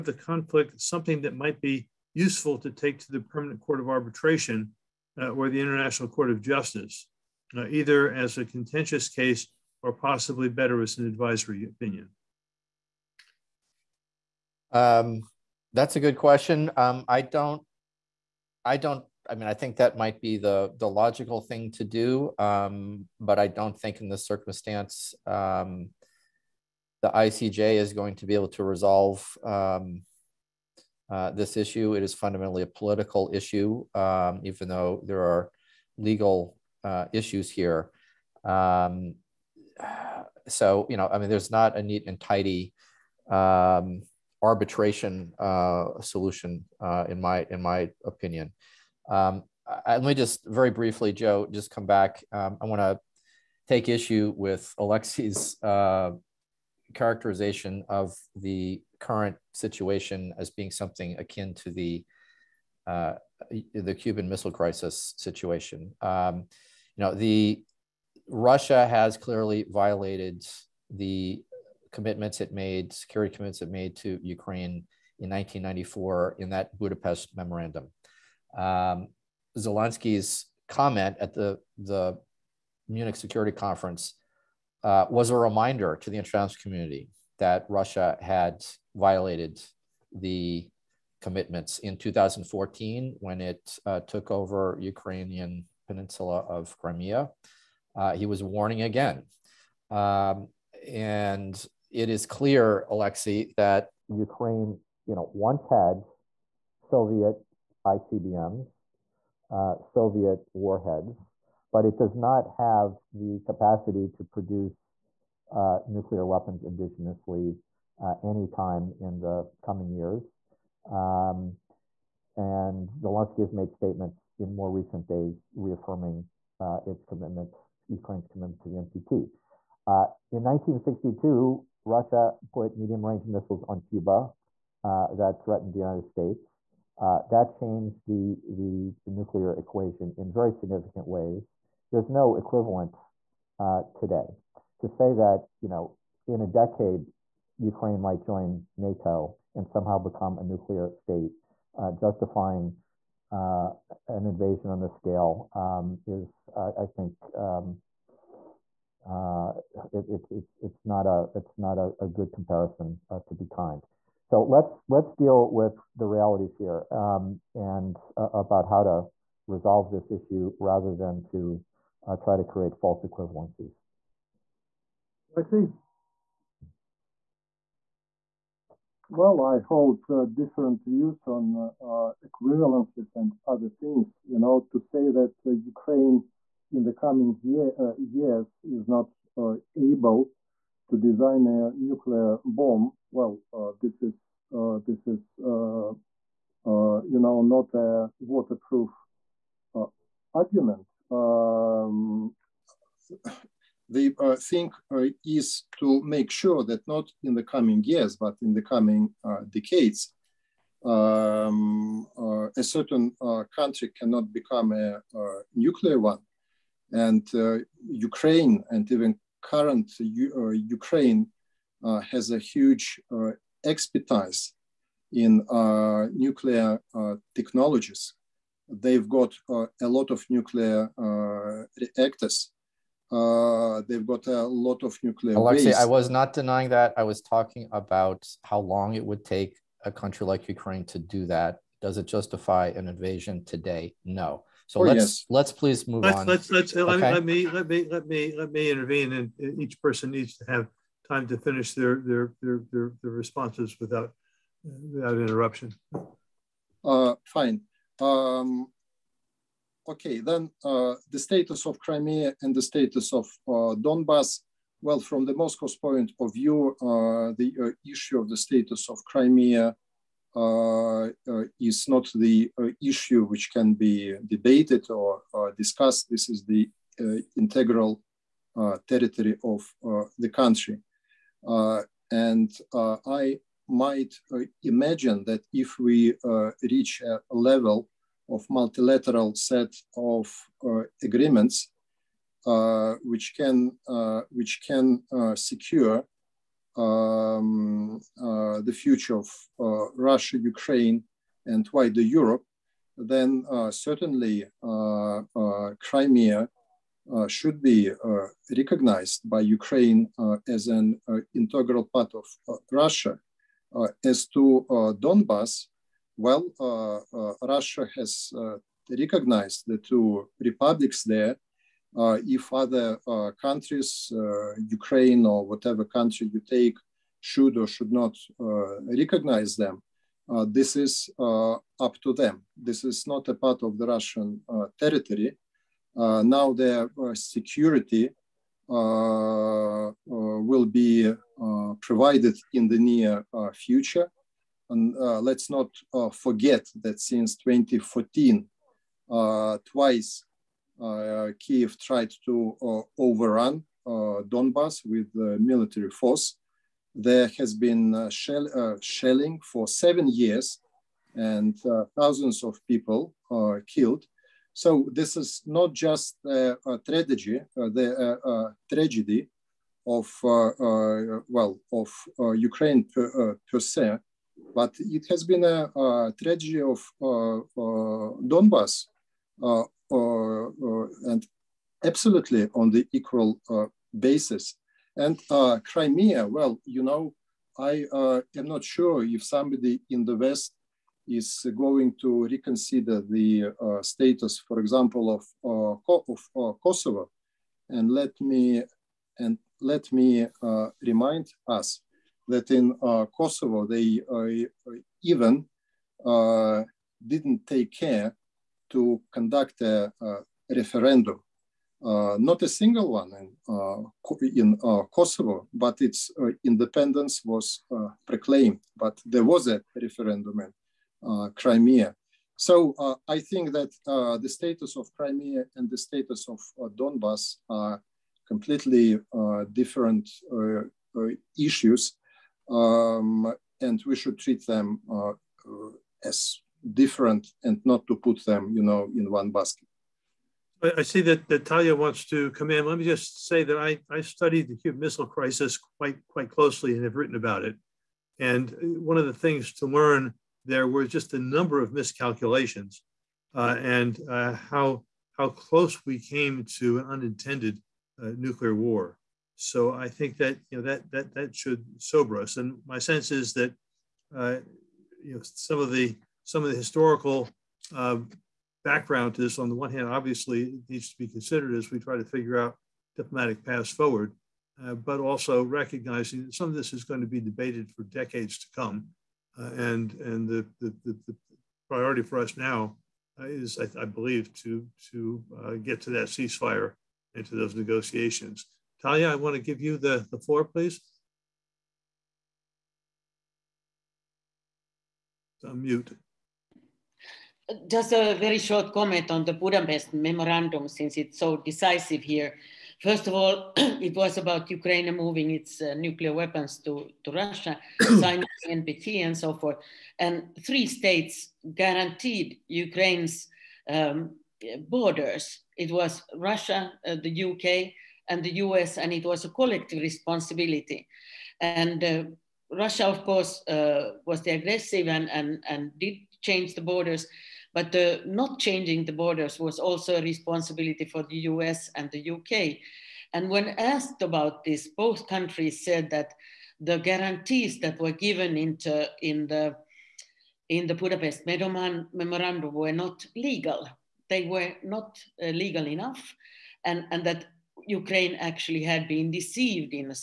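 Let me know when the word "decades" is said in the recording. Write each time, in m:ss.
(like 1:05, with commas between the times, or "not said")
2:26, 3:29, 7:57.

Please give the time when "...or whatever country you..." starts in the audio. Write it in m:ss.
5:25.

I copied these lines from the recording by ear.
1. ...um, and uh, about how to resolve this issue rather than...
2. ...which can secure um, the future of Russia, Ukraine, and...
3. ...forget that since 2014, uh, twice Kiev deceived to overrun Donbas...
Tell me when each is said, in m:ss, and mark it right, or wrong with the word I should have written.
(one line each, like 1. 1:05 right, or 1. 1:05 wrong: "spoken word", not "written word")
1. 2:46 right
2. 4:54 right
3. 5:46 wrong: "tried", not "deceived".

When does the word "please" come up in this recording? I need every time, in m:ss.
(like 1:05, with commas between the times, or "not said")
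4:05, 8:10.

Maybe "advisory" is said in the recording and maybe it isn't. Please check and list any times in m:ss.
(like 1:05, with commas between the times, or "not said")
0:11.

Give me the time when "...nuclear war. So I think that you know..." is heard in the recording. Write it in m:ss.
7:38.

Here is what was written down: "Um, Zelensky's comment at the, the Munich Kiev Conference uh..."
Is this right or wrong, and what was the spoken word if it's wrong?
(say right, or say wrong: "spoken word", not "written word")
wrong: "Security", not "Kiev".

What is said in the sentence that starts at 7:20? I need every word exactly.
I see that, that Tarja wants to come in.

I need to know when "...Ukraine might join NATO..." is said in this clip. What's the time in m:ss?
2:27.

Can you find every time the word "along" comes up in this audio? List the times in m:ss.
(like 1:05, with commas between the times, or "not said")
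not said.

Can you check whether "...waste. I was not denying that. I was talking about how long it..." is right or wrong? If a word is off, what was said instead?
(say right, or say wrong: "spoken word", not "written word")
right.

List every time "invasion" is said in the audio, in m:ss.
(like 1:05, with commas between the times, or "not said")
2:34, 4:02.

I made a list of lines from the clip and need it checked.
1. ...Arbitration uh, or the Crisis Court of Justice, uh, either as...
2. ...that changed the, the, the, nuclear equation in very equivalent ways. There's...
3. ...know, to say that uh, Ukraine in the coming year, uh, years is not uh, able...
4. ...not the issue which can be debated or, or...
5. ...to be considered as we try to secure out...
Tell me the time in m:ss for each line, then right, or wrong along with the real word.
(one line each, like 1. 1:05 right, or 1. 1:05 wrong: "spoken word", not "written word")
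1. 0:03 wrong: "International", not "Crisis"
2. 2:17 wrong: "significant", not "equivalent"
3. 3:04 right
4. 4:31 right
5. 7:50 wrong: "figure", not "secure".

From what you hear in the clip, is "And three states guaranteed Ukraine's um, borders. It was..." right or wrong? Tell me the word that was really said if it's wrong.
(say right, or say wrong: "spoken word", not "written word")
right.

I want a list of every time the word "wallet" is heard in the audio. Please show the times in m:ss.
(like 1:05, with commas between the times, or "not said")
not said.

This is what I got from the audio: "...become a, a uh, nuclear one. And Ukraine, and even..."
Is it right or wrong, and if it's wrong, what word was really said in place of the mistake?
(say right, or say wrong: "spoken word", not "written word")
right.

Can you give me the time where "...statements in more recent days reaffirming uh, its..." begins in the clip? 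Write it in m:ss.
2:03.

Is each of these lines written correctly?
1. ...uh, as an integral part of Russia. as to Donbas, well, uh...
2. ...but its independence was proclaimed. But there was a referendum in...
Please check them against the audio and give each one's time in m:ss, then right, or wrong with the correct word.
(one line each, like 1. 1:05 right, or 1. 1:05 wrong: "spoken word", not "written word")
1. 5:10 right
2. 6:55 right.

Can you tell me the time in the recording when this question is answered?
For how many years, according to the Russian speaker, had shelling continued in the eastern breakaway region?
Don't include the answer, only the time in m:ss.
5:59.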